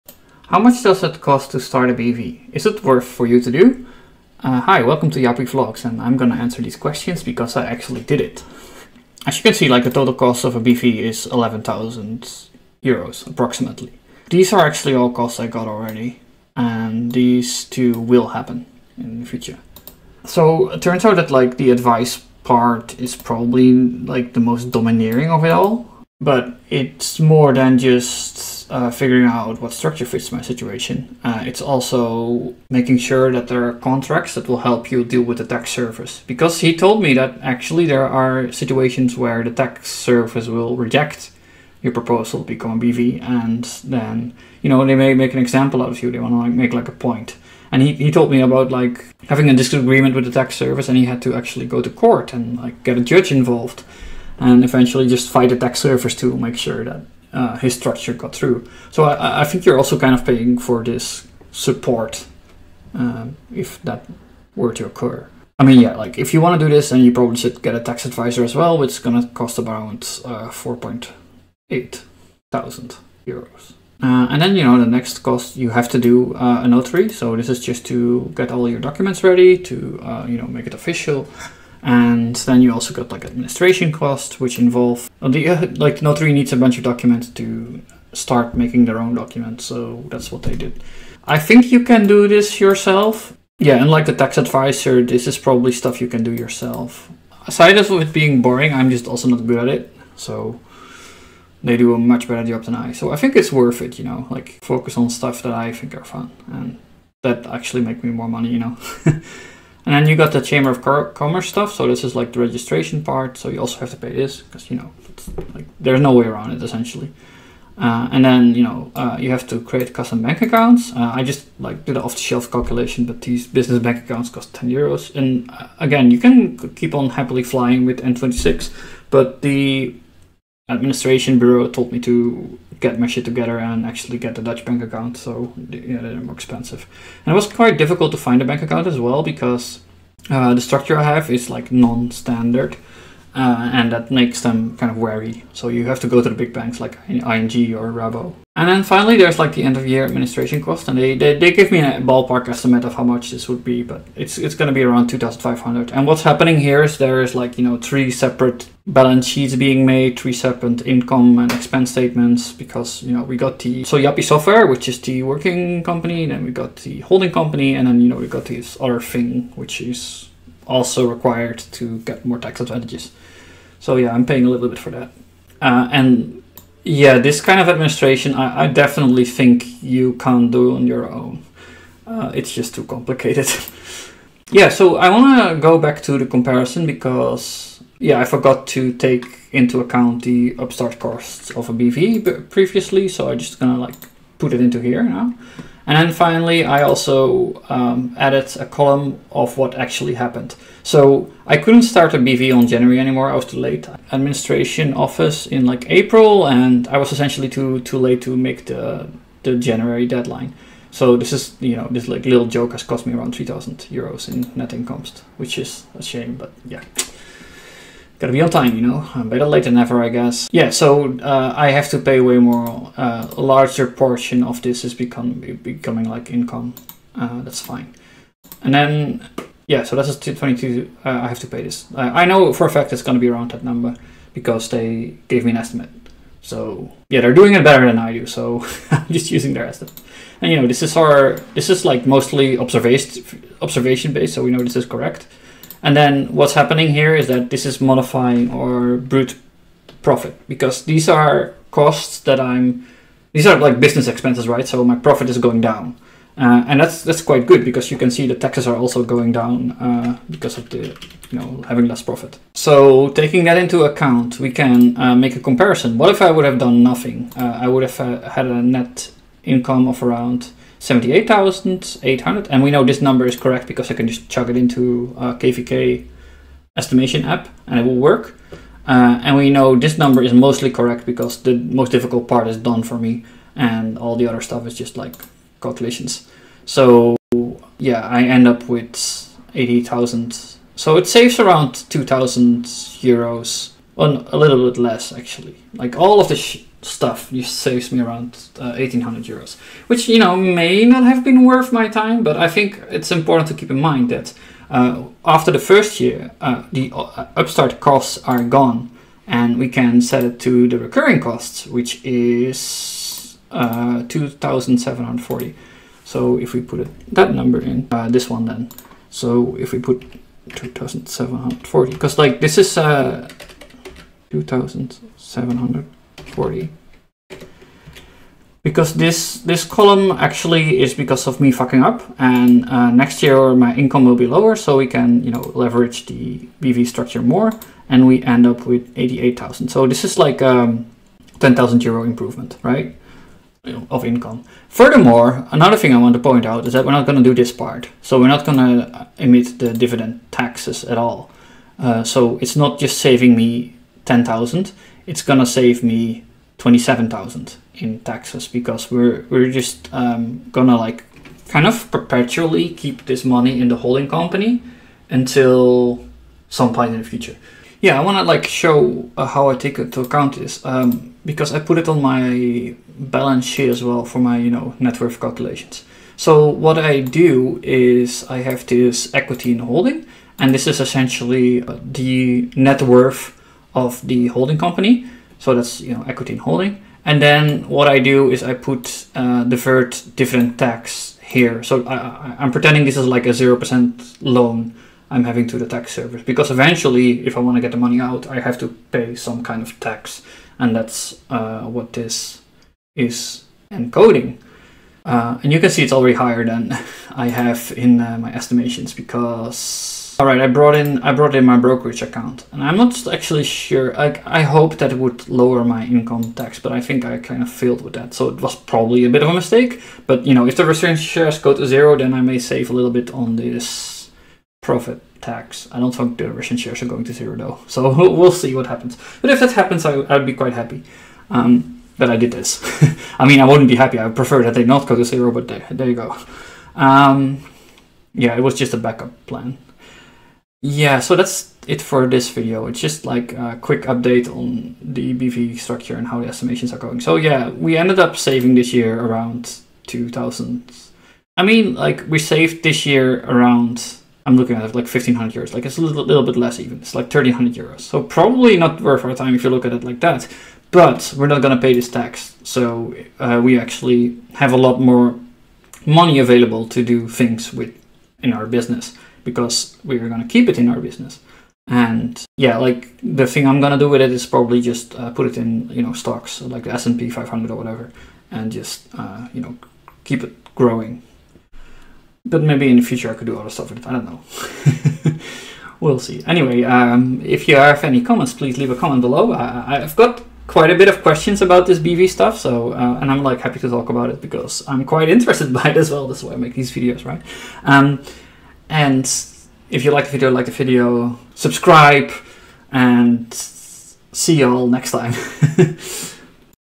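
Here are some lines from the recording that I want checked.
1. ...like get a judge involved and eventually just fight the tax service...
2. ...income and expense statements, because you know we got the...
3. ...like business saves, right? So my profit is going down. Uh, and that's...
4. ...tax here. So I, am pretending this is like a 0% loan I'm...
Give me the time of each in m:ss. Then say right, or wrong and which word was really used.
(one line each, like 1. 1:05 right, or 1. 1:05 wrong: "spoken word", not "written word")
1. 0:52 right
2. 2:40 right
3. 4:13 wrong: "expenses", not "saves"
4. 6:30 right.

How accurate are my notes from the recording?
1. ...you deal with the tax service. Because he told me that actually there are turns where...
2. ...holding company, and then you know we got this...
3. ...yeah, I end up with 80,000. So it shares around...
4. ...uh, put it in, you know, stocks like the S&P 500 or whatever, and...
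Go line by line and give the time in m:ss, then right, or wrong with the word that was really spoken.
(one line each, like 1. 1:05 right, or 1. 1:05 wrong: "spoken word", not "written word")
1. 0:34 wrong: "situations", not "turns"
2. 2:47 right
3. 4:47 wrong: "saves", not "shares"
4. 7:54 right.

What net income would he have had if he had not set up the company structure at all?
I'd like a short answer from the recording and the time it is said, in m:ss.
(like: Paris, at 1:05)
78,800, at 4:30.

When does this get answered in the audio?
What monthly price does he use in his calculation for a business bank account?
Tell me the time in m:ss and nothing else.
2:04.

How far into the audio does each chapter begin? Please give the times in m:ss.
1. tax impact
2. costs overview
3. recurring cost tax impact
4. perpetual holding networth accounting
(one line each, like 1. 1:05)
1. 3:03
2. 0:10
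3. 5:11
4. 6:07.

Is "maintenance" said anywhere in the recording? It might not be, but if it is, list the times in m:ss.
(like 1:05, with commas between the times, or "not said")
not said.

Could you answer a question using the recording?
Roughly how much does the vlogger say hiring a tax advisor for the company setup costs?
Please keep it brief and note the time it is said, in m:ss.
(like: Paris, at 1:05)
4,800 euros, at 1:10.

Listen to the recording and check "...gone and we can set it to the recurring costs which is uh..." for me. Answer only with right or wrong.
right.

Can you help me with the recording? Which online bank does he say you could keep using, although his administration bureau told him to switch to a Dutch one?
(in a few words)
N26.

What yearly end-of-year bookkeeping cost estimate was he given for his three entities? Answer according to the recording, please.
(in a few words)
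2,500.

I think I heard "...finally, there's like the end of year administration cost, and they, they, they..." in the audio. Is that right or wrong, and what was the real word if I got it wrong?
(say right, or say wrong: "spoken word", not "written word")
right.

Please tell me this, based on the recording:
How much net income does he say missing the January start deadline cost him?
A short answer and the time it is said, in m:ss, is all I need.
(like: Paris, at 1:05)
3,000 euros, at 3:33.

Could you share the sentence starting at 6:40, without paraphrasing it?
And that's uh, what this is encoding.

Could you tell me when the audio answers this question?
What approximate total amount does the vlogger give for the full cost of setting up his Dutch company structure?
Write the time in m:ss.
0:11.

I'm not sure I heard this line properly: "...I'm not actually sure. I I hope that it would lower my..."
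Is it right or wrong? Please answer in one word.
right.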